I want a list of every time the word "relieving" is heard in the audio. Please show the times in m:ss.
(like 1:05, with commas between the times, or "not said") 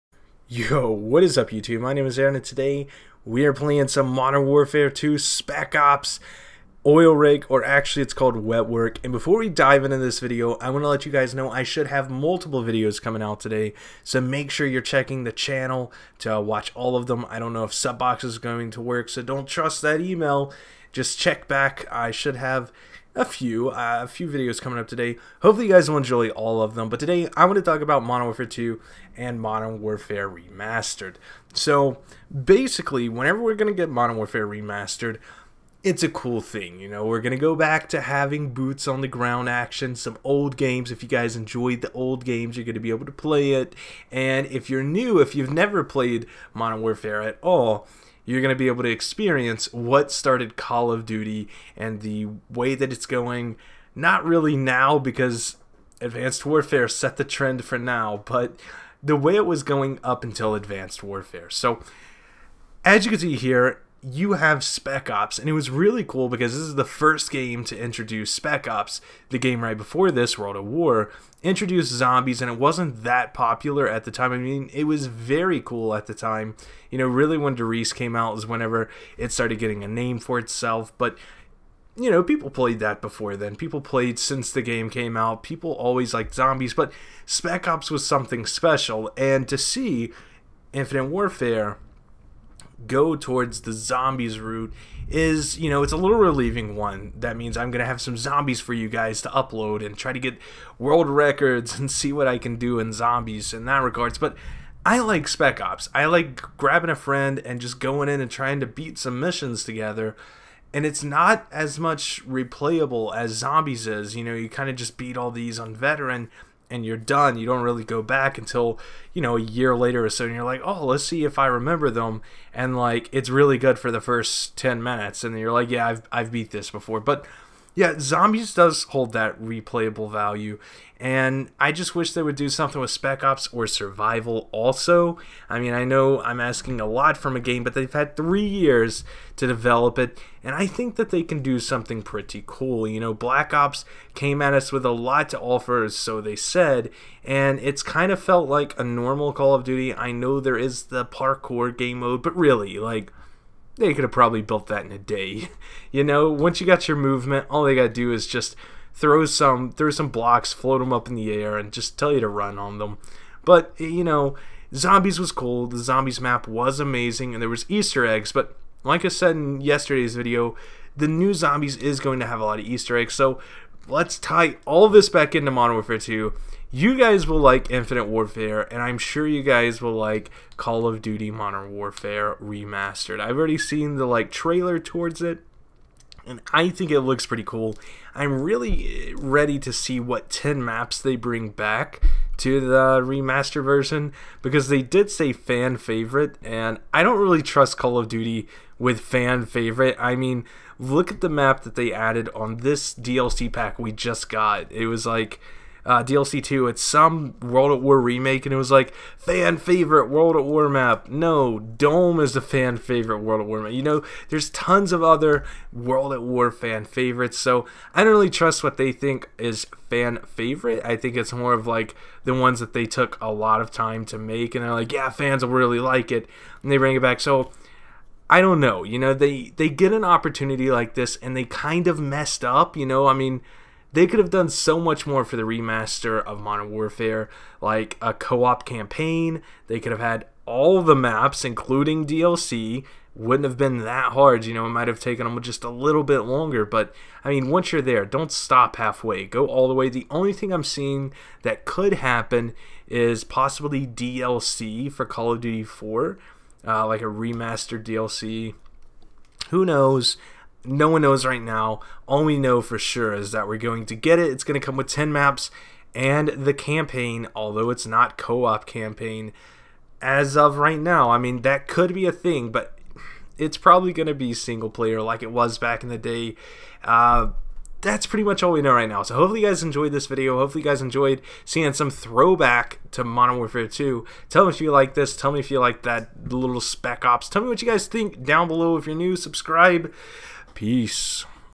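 1:36.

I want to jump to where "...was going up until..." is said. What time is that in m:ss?
0:59.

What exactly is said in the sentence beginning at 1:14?
I mean, it was very cool at the time.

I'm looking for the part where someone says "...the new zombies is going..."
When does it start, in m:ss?
2:50.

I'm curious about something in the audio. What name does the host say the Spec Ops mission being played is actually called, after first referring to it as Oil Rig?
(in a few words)
Wet Work.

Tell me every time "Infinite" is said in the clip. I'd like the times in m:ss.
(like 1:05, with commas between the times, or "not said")
1:30, 2:57.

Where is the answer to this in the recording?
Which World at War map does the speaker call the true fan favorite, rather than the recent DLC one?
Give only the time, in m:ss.
3:31.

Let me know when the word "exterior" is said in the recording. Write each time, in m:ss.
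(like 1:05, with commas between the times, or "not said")
not said.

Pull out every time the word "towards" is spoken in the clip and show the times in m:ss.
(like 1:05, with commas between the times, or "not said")
1:33, 3:04.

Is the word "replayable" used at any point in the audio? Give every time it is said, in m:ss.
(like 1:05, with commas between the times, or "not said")
1:52, 2:09.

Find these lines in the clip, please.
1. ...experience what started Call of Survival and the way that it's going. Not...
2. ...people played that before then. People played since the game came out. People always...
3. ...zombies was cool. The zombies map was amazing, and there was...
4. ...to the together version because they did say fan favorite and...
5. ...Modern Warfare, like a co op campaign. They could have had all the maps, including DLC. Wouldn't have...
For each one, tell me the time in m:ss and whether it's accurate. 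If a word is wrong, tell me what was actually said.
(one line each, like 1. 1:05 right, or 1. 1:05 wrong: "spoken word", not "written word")
1. 0:48 wrong: "Duty", not "Survival"
2. 1:22 right
3. 2:44 right
4. 3:12 wrong: "remaster", not "together"
5. 3:56 right.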